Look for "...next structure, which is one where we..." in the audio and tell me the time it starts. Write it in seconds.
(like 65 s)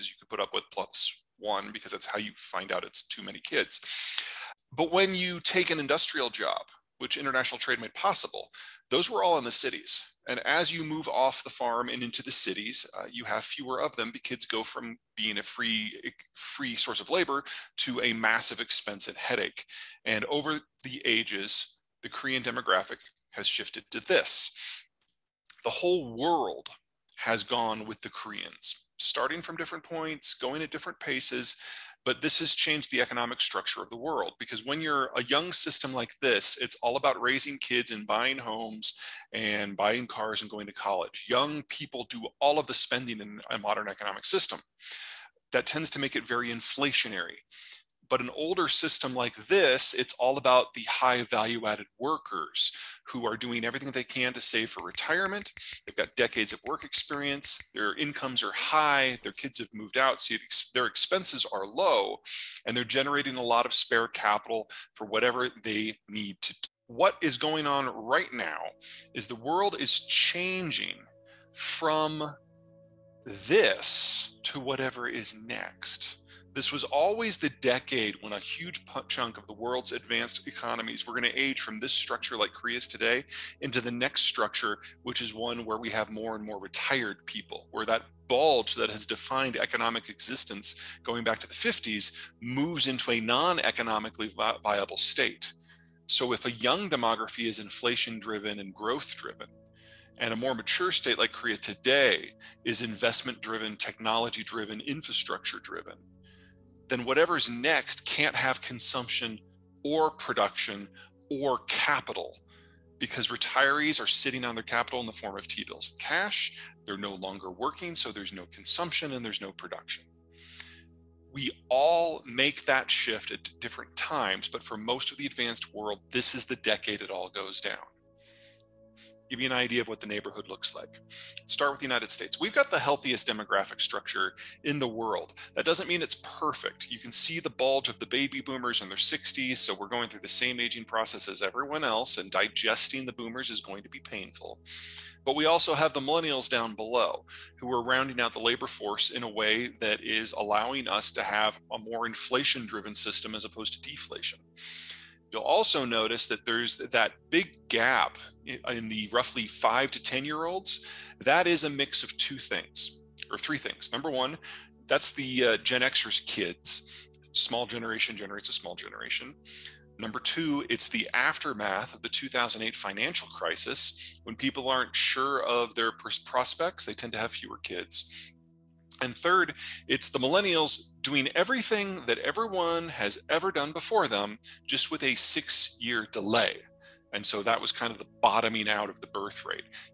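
83 s.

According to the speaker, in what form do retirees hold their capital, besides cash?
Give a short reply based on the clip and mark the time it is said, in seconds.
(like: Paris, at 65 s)
T bills, at 115 s.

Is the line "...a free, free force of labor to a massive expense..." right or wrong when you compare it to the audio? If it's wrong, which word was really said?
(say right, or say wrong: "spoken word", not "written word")
wrong: "source", not "force".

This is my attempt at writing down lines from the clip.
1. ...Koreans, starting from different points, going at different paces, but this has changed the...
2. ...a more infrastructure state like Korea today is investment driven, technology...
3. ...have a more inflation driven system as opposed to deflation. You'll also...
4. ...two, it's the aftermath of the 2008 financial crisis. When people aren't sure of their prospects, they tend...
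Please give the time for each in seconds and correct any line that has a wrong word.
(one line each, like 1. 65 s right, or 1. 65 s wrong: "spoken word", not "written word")
1. 28 s right
2. 100 s wrong: "mature", not "infrastructure"
3. 151 s right
4. 170 s right.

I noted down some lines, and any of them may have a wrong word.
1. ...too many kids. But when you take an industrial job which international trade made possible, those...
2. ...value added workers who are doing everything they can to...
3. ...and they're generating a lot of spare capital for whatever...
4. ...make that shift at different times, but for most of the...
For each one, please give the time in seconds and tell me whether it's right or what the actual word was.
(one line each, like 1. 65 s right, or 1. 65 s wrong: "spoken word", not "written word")
1. 3 s right
2. 51 s right
3. 62 s right
4. 122 s right.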